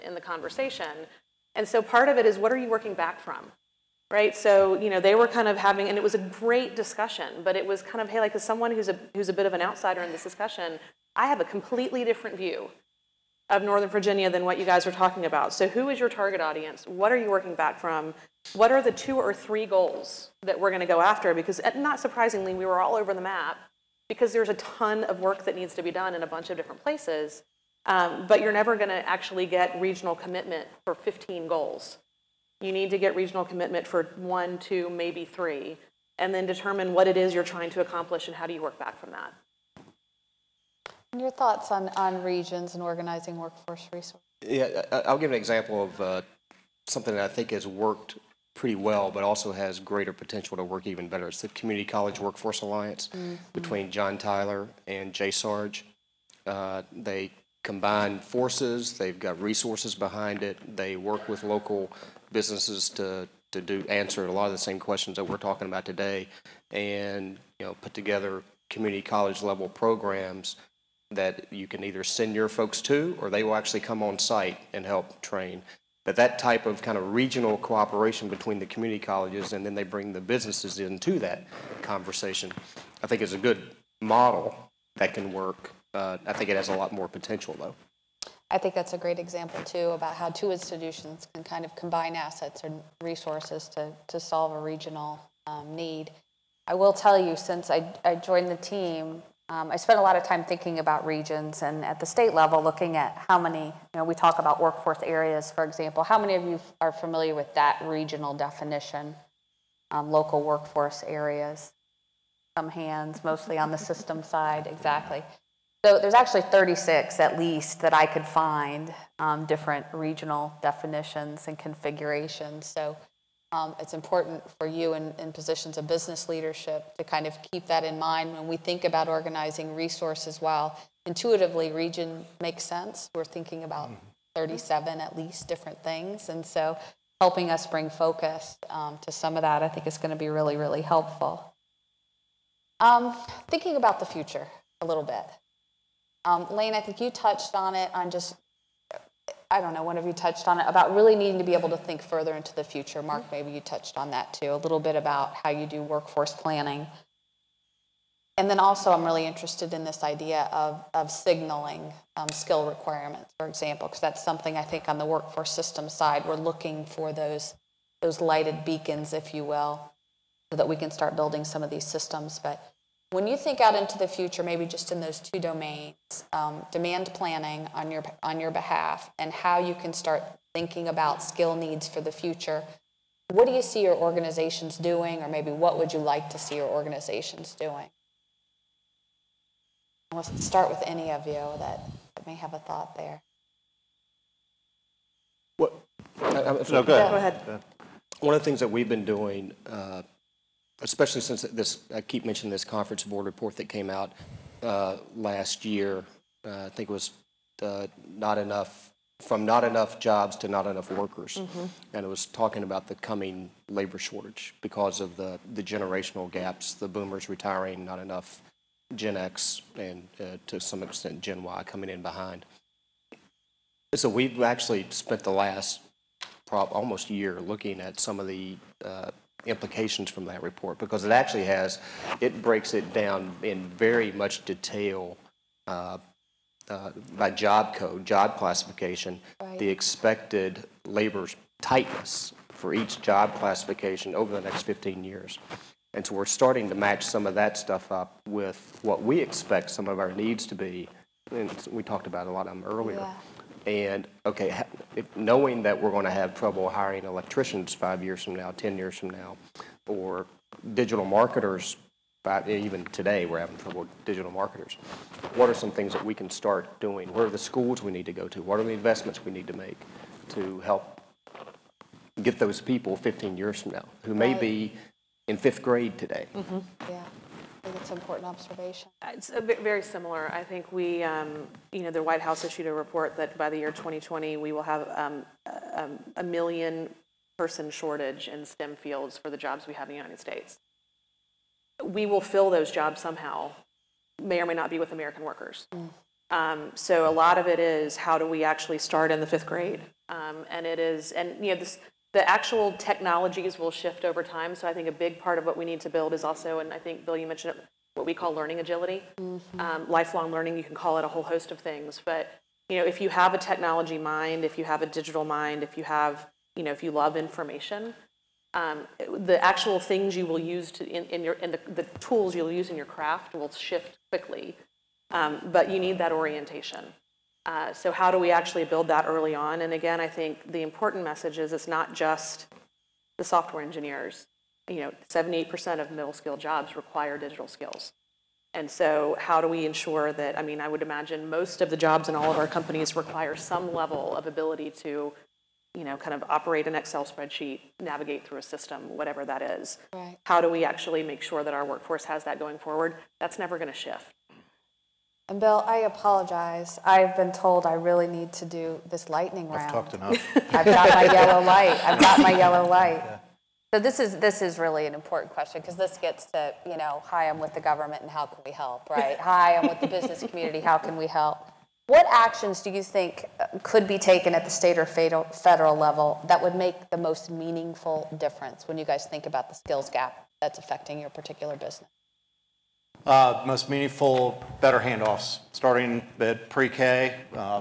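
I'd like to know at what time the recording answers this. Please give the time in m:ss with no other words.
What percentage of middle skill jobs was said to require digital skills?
5:35.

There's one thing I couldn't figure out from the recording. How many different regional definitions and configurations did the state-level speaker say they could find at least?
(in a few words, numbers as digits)
36.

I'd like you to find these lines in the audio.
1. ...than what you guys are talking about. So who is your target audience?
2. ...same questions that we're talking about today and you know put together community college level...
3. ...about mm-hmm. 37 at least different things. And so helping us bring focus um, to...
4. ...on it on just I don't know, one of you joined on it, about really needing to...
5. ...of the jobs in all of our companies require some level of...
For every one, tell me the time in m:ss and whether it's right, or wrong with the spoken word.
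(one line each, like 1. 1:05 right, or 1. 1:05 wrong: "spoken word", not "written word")
1. 0:14 right
2. 1:04 right
3. 2:13 right
4. 2:27 wrong: "touched", not "joined"
5. 5:41 right.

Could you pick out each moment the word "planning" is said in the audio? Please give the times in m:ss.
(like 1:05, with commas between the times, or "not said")
2:36, 2:57.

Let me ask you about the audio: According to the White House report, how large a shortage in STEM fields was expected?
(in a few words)
1 million people.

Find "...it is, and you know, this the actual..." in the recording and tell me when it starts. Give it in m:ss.
5:00.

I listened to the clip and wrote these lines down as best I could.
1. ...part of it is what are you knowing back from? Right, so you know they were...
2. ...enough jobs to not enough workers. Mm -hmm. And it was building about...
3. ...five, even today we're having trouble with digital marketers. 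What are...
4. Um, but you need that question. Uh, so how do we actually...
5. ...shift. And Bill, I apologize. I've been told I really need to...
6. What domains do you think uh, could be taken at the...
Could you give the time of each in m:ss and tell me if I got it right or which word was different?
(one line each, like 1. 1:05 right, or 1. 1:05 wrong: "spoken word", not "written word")
1. 0:01 wrong: "working", not "knowing"
2. 3:29 wrong: "talking", not "building"
3. 4:22 right
4. 5:25 wrong: "orientation", not "question"
5. 5:53 right
6. 6:11 wrong: "actions", not "domains".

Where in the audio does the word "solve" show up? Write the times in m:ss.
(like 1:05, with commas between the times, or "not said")
1:34.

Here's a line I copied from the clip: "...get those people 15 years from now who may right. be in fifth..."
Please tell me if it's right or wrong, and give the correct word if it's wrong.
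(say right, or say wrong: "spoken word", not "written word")
right.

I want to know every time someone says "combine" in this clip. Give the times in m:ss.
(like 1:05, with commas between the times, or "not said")
0:57, 1:31.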